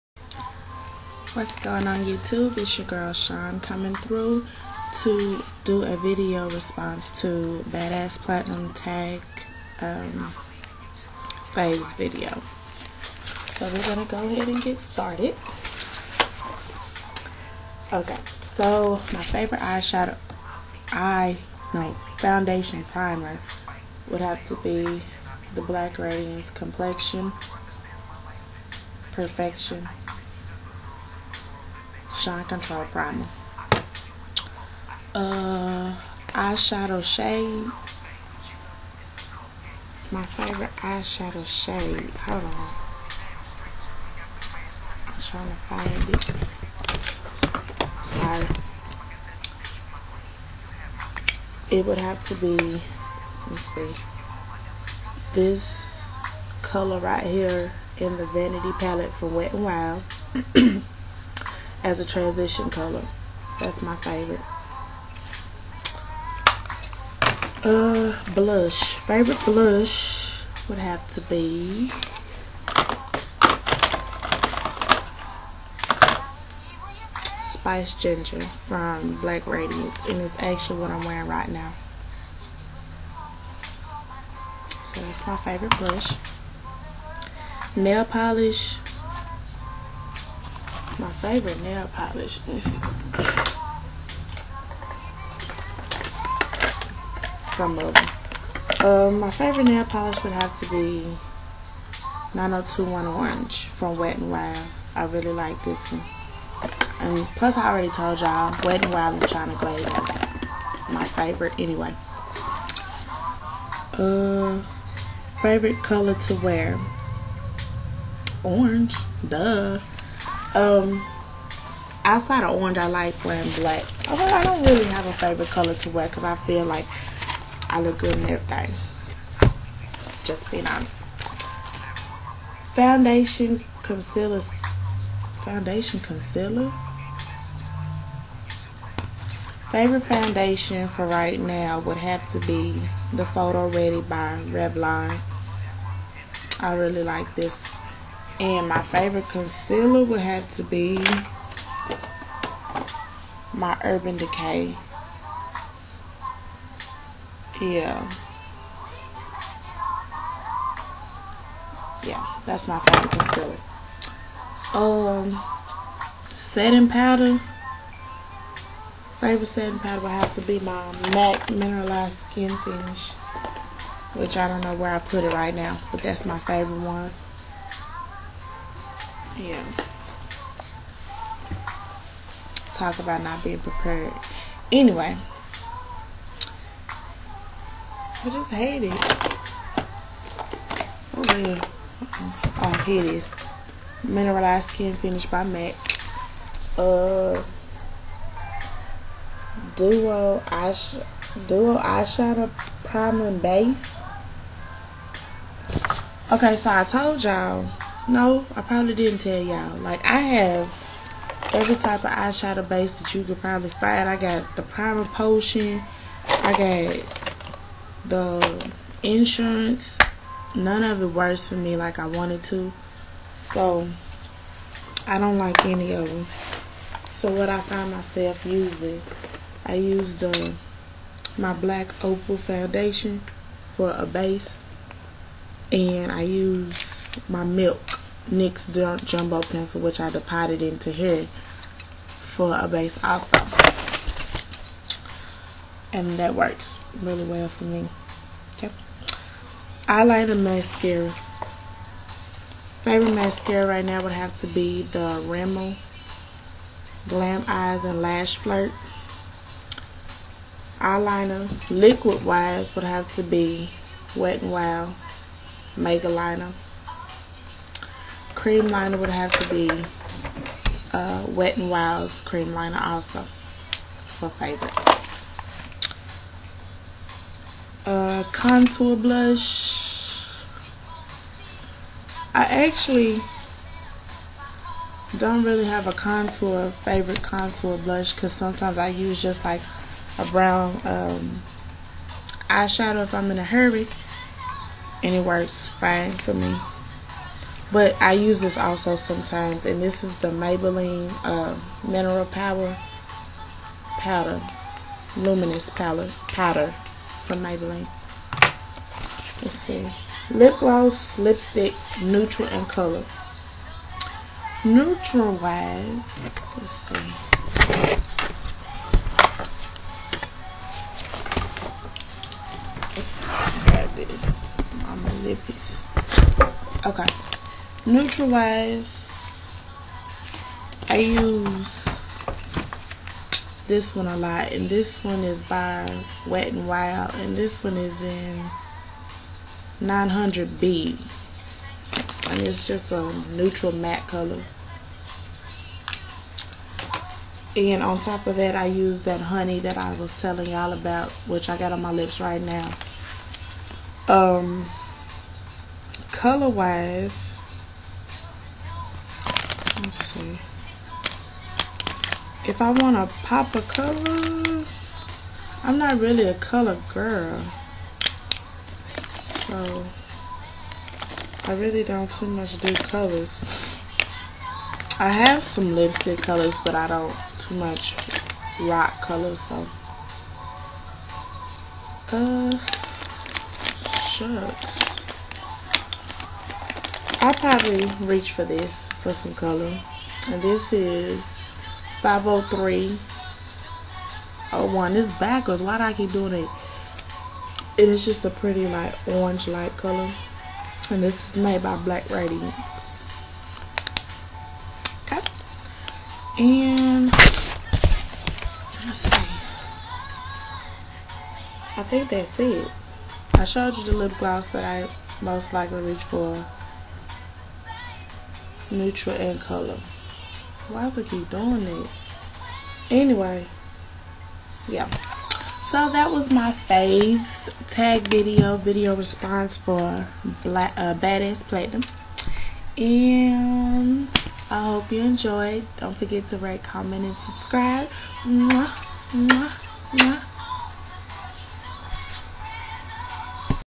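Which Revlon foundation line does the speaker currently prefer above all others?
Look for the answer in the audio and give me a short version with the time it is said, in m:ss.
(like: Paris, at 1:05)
Photo Ready, at 2:23.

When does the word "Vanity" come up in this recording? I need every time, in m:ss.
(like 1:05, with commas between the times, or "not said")
0:58.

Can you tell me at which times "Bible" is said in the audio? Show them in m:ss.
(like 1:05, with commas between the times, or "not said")
not said.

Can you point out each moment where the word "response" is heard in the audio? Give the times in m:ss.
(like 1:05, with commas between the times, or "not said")
0:06, 7:08.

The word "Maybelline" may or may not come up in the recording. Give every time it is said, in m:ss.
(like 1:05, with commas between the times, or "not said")
5:00, 5:07.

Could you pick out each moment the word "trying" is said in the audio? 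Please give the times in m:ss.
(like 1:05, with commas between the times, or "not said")
0:45.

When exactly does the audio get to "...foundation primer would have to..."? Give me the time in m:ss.
0:22.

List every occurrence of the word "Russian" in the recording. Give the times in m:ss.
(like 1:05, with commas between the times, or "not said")
not said.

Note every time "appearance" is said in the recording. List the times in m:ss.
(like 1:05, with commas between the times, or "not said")
not said.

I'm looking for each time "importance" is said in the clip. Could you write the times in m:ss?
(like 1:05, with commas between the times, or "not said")
not said.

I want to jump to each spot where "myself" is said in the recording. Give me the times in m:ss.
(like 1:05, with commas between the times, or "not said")
3:47.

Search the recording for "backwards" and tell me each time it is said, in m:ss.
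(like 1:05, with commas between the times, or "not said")
6:35.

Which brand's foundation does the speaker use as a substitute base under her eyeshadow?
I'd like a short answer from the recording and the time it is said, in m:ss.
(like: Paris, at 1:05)
Black Opal, at 3:51.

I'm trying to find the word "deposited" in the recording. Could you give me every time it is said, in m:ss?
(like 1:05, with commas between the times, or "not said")
4:00.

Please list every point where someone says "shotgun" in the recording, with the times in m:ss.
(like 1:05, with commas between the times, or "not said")
not said.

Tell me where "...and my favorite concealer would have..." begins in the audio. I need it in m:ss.
2:28.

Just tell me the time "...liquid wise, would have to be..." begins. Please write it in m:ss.
4:21.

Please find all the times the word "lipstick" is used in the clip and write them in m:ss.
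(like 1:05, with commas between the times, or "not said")
5:11, 6:15.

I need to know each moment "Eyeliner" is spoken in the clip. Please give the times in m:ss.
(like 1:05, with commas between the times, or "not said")
4:09, 4:20.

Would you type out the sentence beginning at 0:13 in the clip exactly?
So we're going to go ahead and get started.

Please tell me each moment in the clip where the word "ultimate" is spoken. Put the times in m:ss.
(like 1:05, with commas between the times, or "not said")
not said.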